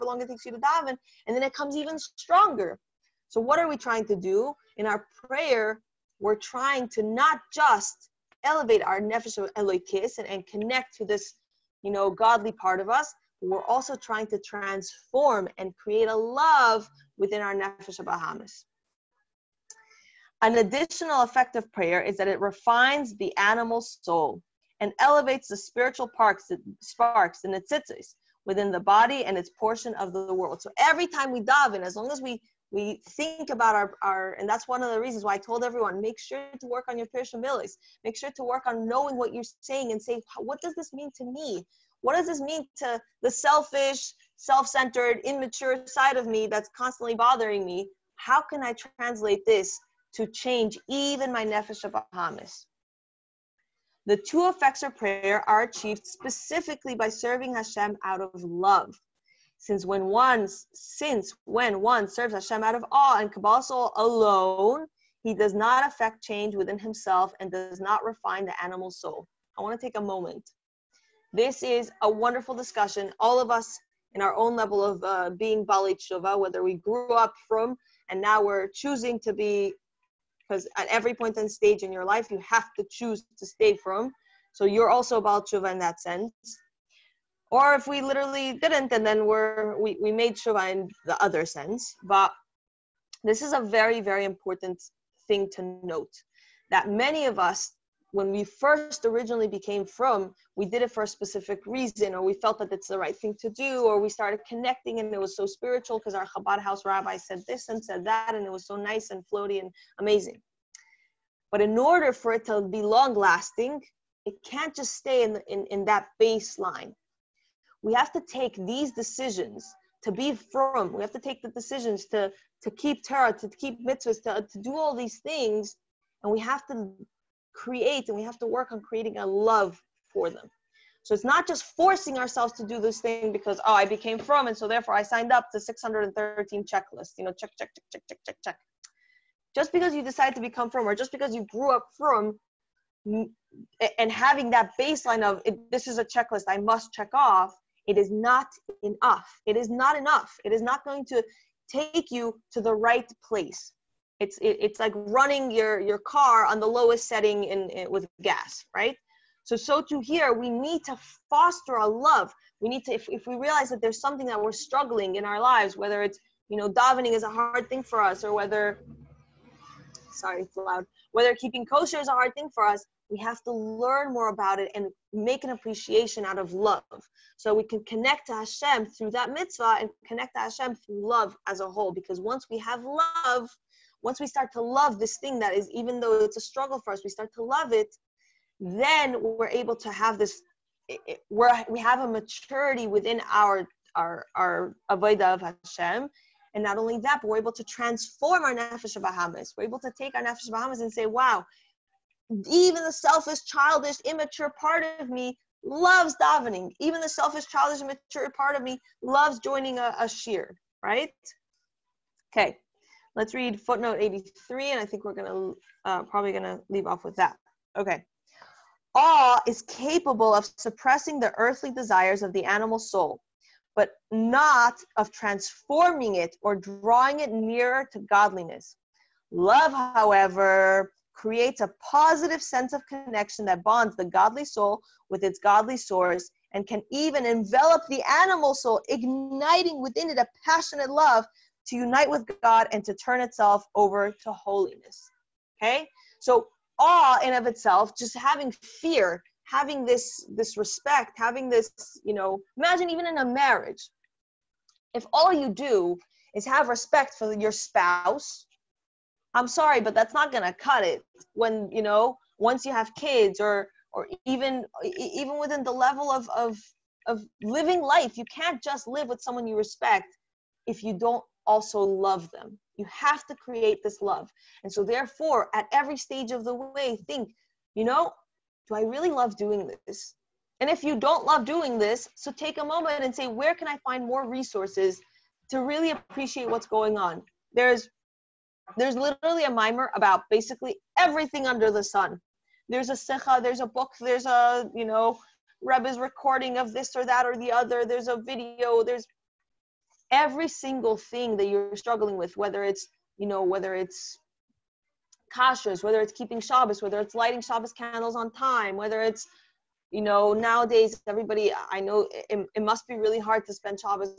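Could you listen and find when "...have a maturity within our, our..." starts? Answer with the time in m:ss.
3:11.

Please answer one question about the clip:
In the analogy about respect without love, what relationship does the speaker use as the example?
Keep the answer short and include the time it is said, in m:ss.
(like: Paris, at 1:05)
marriage, at 4:13.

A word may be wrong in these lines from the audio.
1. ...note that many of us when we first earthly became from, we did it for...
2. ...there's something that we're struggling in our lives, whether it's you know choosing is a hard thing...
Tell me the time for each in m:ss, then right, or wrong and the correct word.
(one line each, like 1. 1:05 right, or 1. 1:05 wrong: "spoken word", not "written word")
1. 1:35 wrong: "originally", not "earthly"
2. 2:43 wrong: "davening", not "choosing".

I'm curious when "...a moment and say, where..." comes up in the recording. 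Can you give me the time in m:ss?
4:42.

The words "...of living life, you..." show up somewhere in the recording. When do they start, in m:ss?
4:27.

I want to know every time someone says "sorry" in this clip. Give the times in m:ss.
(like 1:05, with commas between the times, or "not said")
2:50, 4:19.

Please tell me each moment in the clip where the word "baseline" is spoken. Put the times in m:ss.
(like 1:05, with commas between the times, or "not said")
1:56, 2:24.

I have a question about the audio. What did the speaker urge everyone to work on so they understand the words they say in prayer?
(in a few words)
pirush hamilos.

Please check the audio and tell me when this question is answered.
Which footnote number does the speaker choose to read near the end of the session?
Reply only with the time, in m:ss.
3:33.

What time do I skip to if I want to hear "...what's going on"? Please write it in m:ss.
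4:46.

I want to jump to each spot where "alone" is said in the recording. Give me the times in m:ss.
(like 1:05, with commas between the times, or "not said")
1:03.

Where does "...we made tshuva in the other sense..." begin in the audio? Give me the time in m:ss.
1:30.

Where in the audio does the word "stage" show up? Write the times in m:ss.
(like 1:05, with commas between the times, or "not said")
1:21, 4:35.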